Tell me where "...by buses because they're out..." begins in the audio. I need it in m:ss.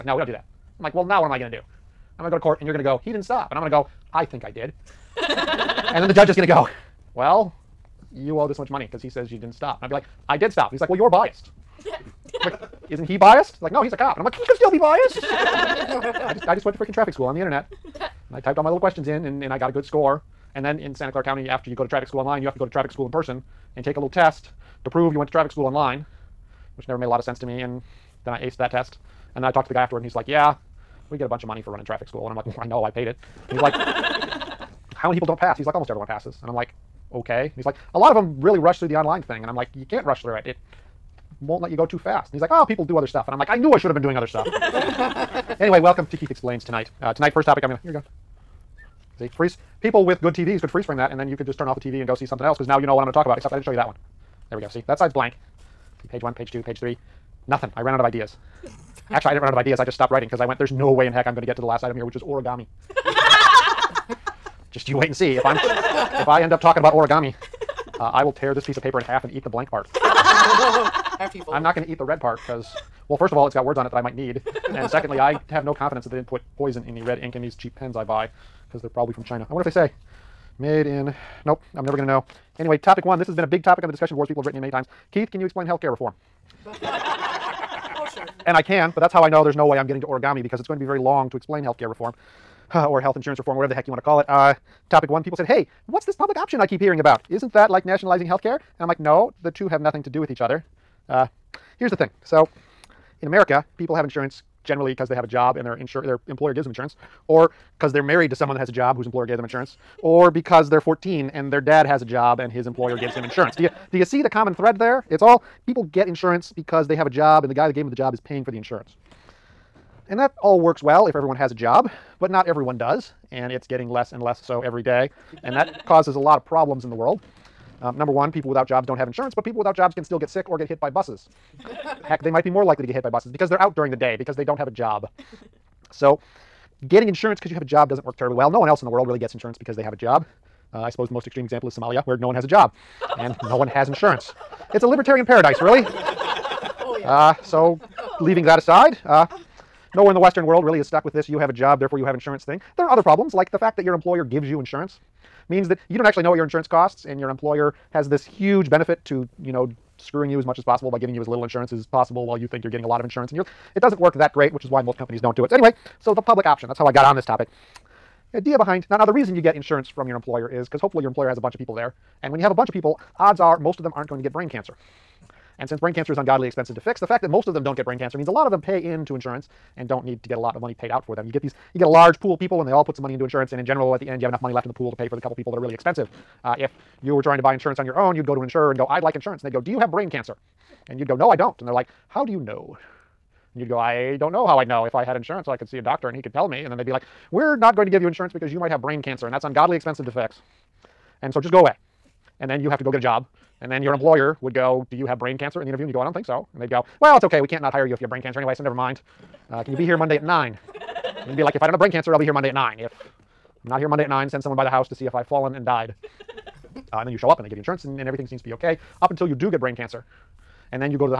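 2:13.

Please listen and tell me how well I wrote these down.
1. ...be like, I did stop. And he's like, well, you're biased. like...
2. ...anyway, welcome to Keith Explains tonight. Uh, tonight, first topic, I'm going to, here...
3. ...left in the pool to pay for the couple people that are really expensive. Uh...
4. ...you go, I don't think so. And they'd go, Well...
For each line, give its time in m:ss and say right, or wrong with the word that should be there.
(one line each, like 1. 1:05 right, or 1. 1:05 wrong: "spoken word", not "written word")
1. 0:09 right
2. 0:45 right
3. 3:04 right
4. 3:25 right.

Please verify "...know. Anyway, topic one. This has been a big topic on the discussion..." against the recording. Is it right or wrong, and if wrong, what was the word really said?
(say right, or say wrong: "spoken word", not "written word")
right.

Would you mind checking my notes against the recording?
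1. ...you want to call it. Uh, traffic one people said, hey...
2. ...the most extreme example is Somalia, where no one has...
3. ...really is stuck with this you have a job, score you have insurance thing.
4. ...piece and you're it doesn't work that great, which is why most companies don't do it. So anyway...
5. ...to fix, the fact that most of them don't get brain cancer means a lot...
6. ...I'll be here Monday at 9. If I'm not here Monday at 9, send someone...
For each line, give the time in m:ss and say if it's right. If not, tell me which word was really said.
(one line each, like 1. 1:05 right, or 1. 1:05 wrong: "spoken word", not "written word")
1. 1:33 wrong: "topic", not "traffic"
2. 2:21 right
3. 2:30 wrong: "therefore", not "score"
4. 2:43 wrong: "insurance", not "piece"
5. 2:56 right
6. 3:32 right.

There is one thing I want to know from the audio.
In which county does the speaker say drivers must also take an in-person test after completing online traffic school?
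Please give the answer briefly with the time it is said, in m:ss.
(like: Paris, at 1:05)
Santa Clara County, at 0:20.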